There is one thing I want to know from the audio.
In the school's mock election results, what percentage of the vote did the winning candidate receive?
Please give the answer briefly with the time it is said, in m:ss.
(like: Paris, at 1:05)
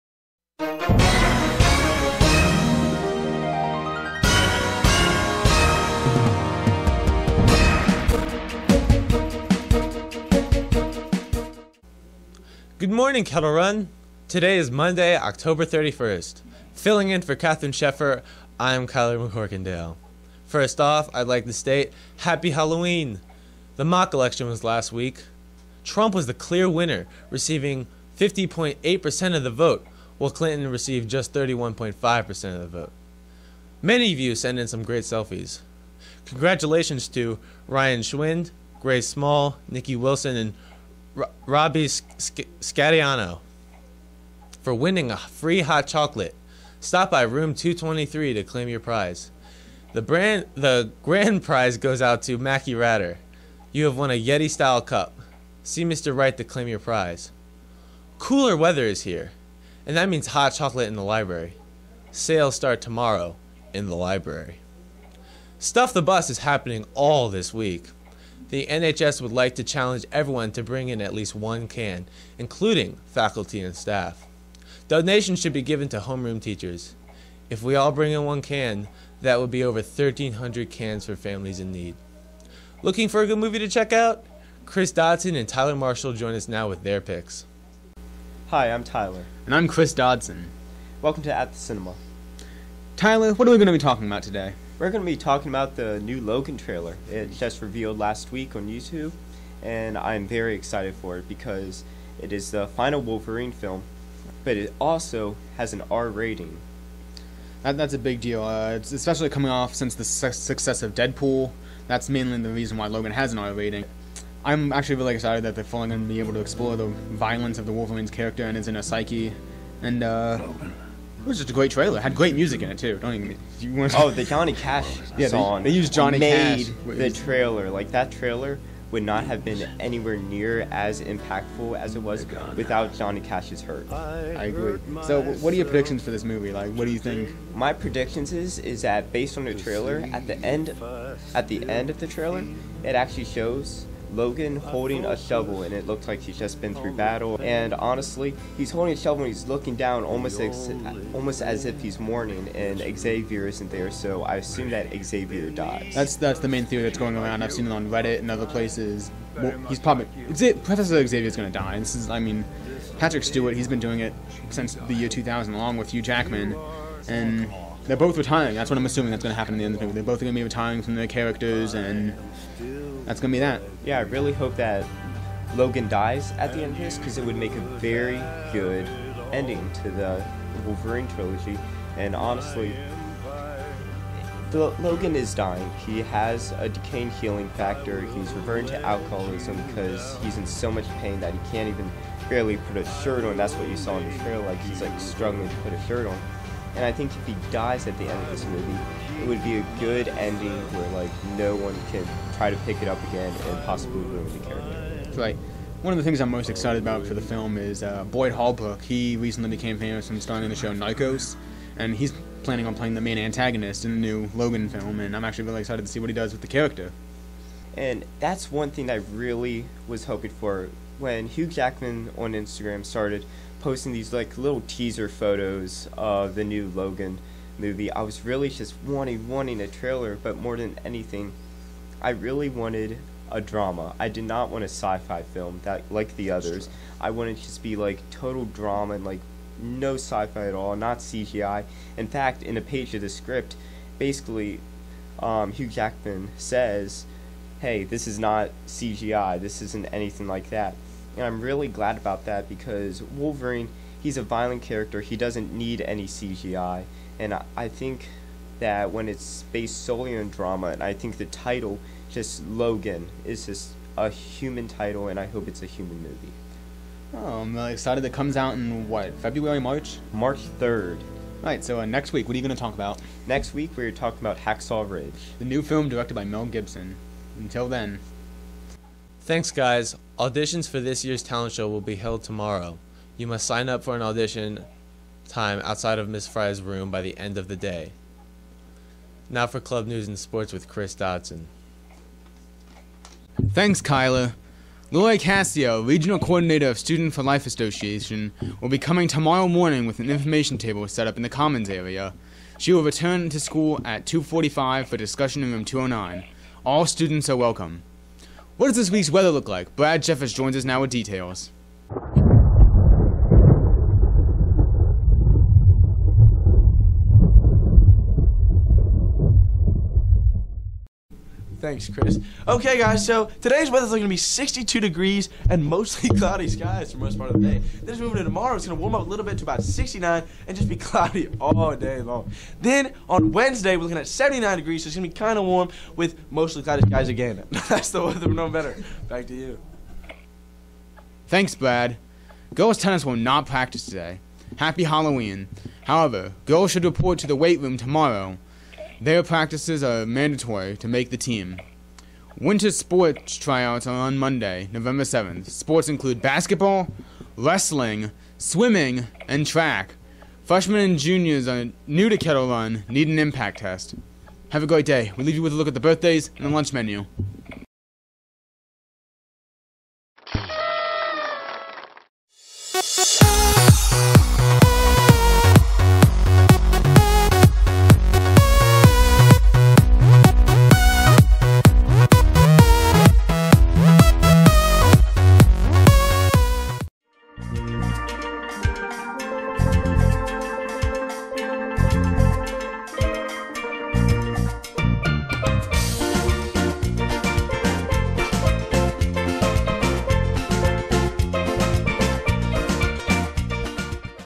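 50.8%, at 0:28.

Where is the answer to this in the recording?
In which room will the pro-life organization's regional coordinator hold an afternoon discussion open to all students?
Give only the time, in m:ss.
5:05.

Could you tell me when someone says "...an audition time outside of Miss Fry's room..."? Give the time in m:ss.
4:43.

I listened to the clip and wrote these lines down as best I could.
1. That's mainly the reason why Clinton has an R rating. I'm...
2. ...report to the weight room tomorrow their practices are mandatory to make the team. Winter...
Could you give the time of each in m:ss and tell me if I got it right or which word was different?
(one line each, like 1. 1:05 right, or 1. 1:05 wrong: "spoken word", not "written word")
1. 1:51 wrong: "Logan", not "Clinton"
2. 5:46 right.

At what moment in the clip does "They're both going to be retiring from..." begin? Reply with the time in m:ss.
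2:49.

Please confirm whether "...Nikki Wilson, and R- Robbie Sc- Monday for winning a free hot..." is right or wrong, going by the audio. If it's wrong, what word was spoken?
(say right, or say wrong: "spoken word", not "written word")
wrong: "Scatiano", not "Monday".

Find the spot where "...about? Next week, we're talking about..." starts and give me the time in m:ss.
4:32.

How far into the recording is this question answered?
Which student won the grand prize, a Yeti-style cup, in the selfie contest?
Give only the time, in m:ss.
0:52.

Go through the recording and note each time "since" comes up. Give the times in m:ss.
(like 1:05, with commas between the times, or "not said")
1:49, 2:44.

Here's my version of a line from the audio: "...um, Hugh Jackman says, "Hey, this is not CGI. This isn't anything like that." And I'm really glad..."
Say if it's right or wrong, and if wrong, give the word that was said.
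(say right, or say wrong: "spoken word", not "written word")
right.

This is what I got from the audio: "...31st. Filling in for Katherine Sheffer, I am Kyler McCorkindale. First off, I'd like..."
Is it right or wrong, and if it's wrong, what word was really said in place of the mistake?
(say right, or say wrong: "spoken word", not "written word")
right.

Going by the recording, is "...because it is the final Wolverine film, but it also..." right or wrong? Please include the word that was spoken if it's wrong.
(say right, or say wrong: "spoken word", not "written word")
right.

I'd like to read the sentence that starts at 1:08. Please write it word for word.
The NHS would like to challenge everyone to bring in at least one can, including faculty and staff.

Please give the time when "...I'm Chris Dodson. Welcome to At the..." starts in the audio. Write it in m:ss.
1:29.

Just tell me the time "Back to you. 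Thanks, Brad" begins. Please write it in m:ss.
5:39.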